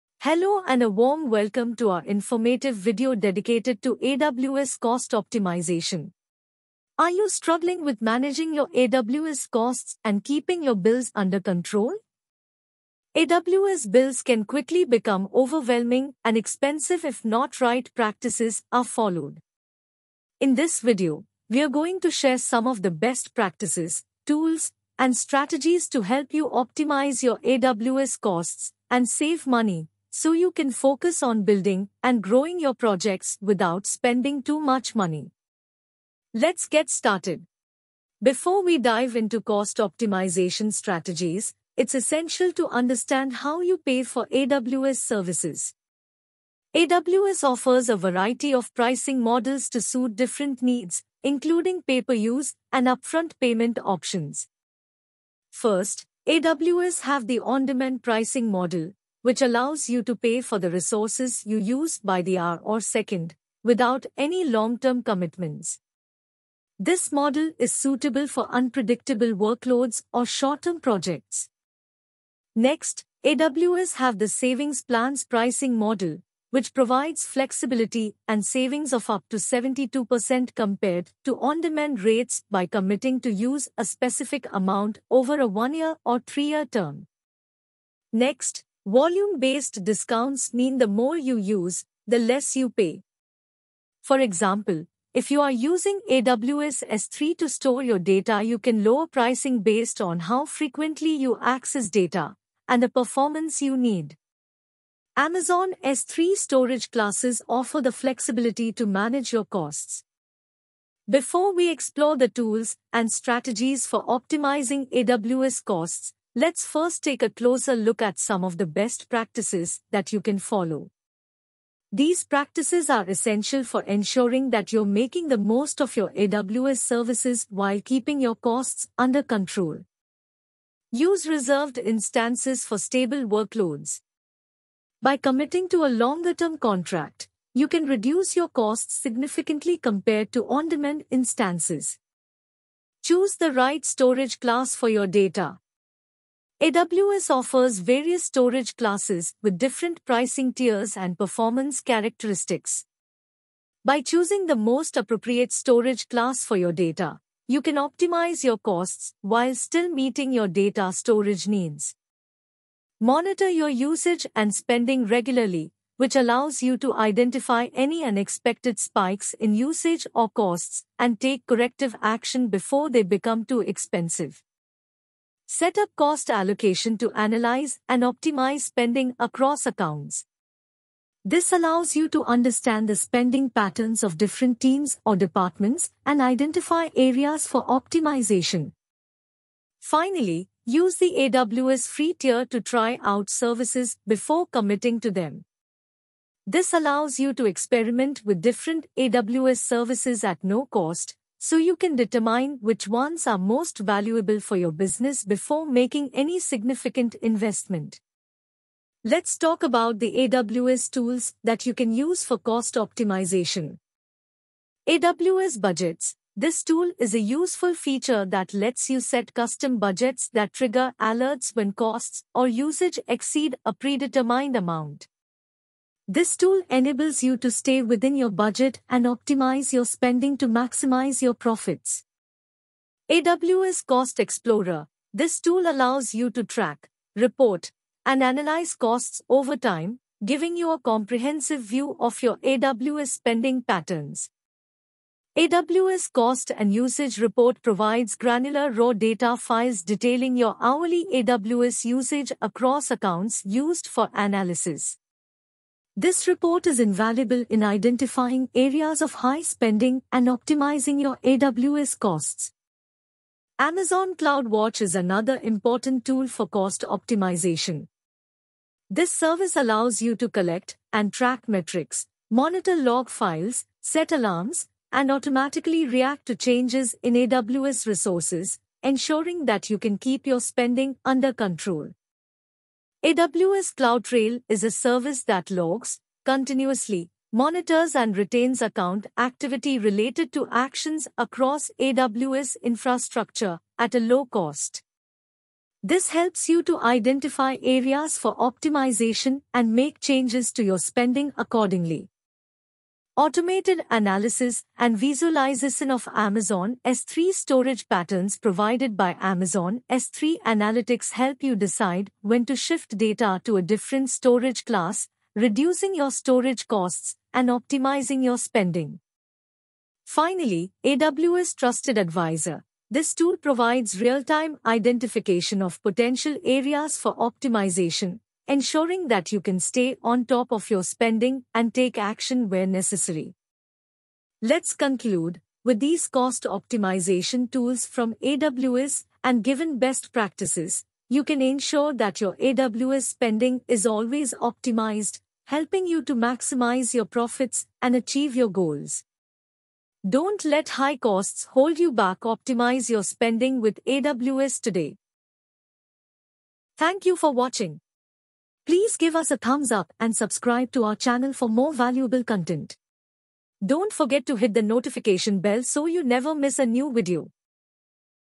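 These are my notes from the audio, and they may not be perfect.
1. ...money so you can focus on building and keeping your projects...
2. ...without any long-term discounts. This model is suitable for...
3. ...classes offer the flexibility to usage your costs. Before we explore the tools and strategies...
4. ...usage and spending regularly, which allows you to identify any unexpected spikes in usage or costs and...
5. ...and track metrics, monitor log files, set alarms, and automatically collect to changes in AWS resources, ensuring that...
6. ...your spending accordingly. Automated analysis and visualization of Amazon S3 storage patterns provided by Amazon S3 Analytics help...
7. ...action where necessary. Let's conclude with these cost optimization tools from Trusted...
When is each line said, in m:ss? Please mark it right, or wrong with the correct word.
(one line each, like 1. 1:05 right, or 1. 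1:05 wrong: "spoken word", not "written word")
1. 0:29 wrong: "growing", not "keeping"
2. 1:03 wrong: "commitments", not "discounts"
3. 1:46 wrong: "manage", not "usage"
4. 2:43 right
5. 4:30 wrong: "react", not "collect"
6. 5:00 right
7. 5:31 wrong: "AWS", not "Trusted".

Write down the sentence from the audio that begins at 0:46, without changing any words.
AWS offers a variety of pricing models to suit different needs, including pay per use and upfront payment options.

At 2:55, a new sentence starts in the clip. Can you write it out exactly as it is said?
Set up cost allocation to analyze and optimize spending across accounts.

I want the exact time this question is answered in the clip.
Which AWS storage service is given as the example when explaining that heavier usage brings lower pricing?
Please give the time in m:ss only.
1:36.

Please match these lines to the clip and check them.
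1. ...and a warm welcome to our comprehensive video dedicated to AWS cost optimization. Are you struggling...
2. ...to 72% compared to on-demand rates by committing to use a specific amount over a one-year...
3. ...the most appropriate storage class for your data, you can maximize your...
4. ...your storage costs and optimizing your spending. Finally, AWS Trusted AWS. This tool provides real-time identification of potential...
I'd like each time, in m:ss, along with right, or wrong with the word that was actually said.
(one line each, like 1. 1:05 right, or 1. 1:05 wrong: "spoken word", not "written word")
1. 0:00 wrong: "informative", not "comprehensive"
2. 1:19 right
3. 2:34 wrong: "optimize", not "maximize"
4. 5:15 wrong: "Advisor", not "AWS".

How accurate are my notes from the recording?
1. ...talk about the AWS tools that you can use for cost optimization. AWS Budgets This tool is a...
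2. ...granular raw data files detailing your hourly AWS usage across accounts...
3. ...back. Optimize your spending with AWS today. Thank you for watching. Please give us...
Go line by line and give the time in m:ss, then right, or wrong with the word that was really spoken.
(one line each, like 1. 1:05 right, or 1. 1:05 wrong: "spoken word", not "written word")
1. 3:29 right
2. 4:08 right
3. 5:51 right.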